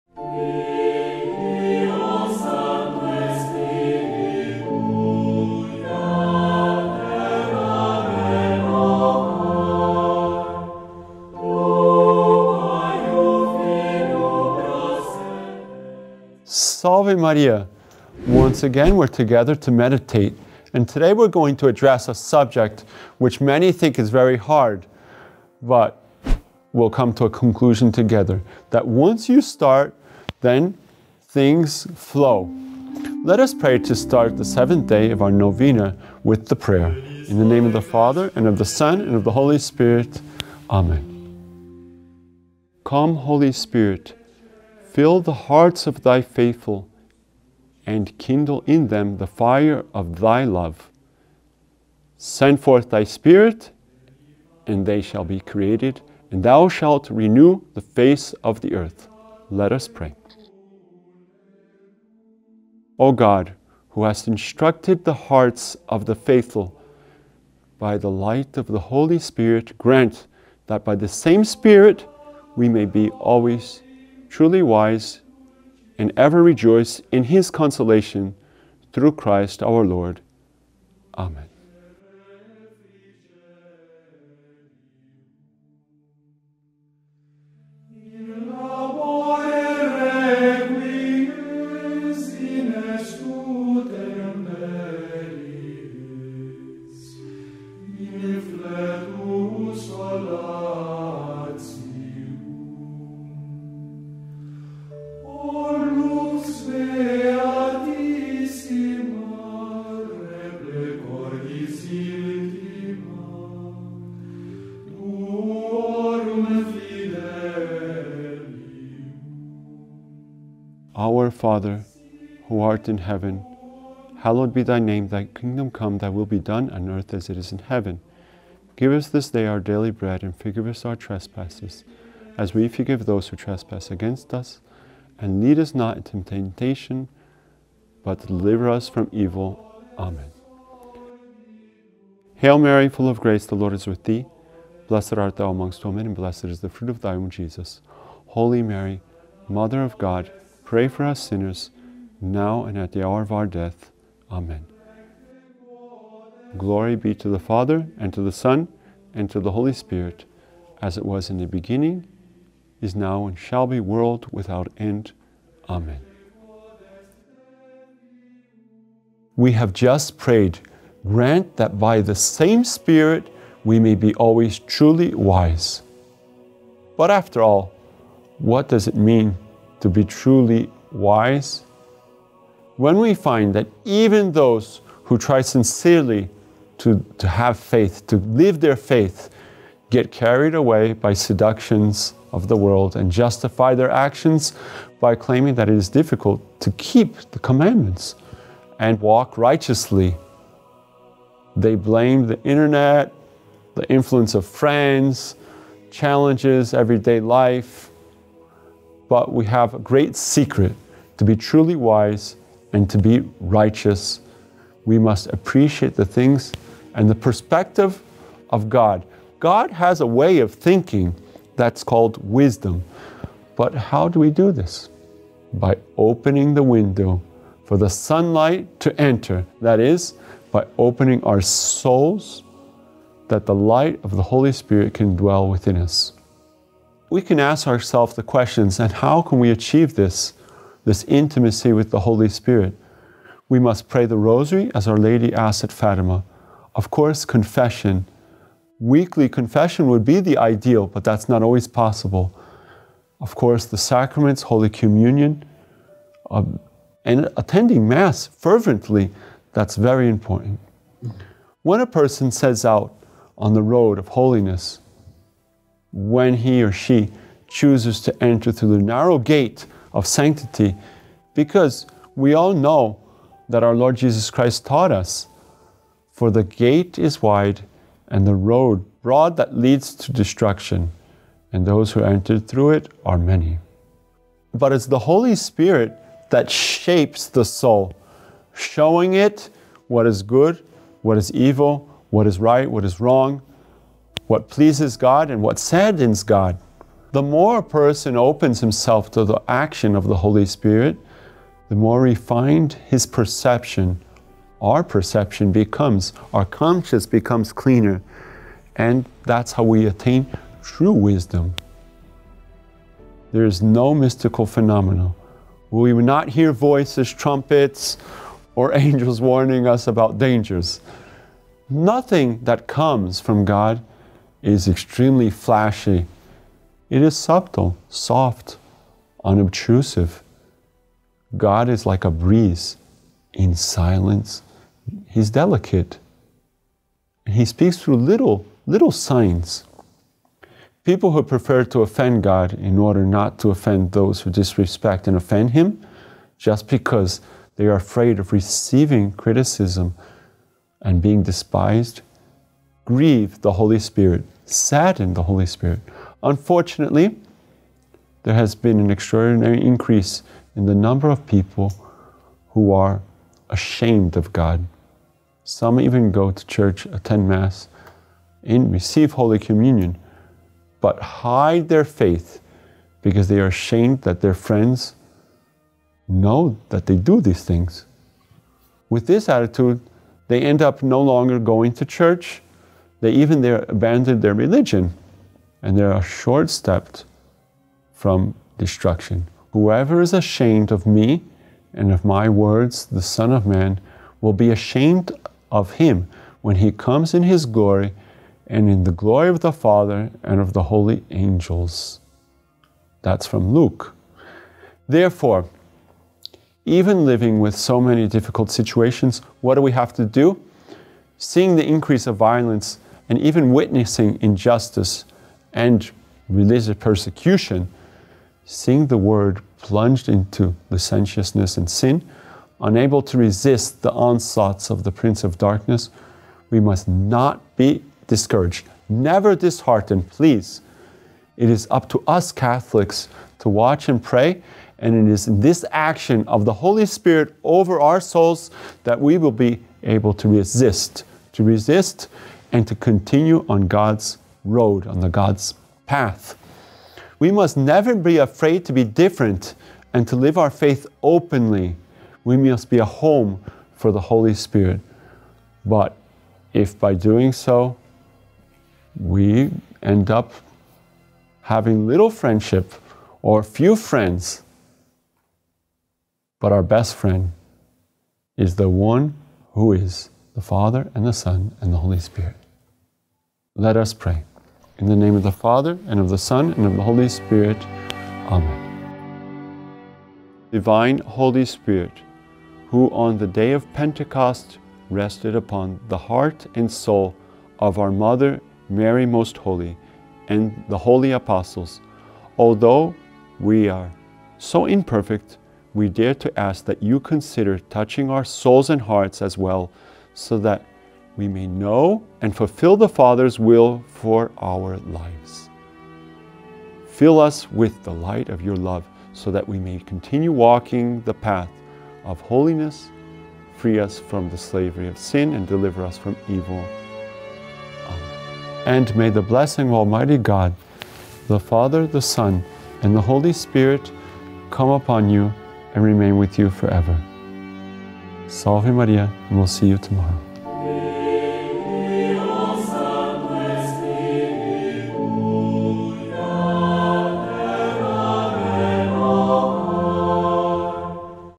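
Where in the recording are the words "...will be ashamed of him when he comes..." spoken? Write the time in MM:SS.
06:34.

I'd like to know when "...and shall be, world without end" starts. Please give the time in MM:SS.
02:43.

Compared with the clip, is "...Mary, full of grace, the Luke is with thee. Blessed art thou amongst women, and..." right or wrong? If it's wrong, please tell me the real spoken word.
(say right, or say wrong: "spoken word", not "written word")
wrong: "Lord", not "Luke".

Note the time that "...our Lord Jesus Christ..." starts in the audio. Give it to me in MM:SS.
04:33.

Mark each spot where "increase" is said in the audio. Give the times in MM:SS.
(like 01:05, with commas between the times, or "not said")
05:59, 06:51.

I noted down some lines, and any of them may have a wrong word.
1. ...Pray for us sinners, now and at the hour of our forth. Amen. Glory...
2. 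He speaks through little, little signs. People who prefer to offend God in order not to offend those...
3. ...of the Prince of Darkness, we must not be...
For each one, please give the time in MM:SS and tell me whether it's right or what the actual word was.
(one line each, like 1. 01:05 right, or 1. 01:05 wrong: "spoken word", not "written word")
1. 02:30 wrong: "death", not "forth"
2. 05:37 right
3. 07:04 right.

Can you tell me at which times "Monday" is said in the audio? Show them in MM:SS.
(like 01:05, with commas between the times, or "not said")
not said.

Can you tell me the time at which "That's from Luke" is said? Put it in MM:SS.
06:43.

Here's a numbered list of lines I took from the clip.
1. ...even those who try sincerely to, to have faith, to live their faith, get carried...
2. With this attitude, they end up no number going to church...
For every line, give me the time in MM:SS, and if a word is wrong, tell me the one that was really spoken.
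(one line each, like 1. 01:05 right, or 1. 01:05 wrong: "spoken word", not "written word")
1. 03:03 right
2. 06:18 wrong: "longer", not "number".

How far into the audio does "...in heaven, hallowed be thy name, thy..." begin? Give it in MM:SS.
02:02.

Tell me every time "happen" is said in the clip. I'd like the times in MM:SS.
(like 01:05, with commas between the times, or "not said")
not said.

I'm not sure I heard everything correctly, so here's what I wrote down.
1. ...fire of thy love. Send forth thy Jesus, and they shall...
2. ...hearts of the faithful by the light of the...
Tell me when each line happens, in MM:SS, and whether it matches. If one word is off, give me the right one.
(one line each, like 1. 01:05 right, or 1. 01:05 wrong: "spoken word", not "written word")
1. 00:49 wrong: "Spirit", not "Jesus"
2. 01:05 right.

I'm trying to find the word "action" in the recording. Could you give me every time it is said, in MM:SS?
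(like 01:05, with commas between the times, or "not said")
03:13, 04:59, 07:15.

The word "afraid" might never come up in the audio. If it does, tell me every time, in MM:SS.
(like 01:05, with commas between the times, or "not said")
05:47, 07:28.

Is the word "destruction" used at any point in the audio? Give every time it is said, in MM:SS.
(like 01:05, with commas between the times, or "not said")
04:40, 06:28.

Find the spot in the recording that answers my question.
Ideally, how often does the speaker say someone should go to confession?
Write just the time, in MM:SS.
04:08.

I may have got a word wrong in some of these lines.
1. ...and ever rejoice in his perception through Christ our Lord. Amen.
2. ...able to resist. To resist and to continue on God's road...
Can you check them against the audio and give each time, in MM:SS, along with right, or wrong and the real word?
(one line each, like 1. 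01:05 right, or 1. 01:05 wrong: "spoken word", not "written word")
1. 01:15 wrong: "consolation", not "perception"
2. 07:19 right.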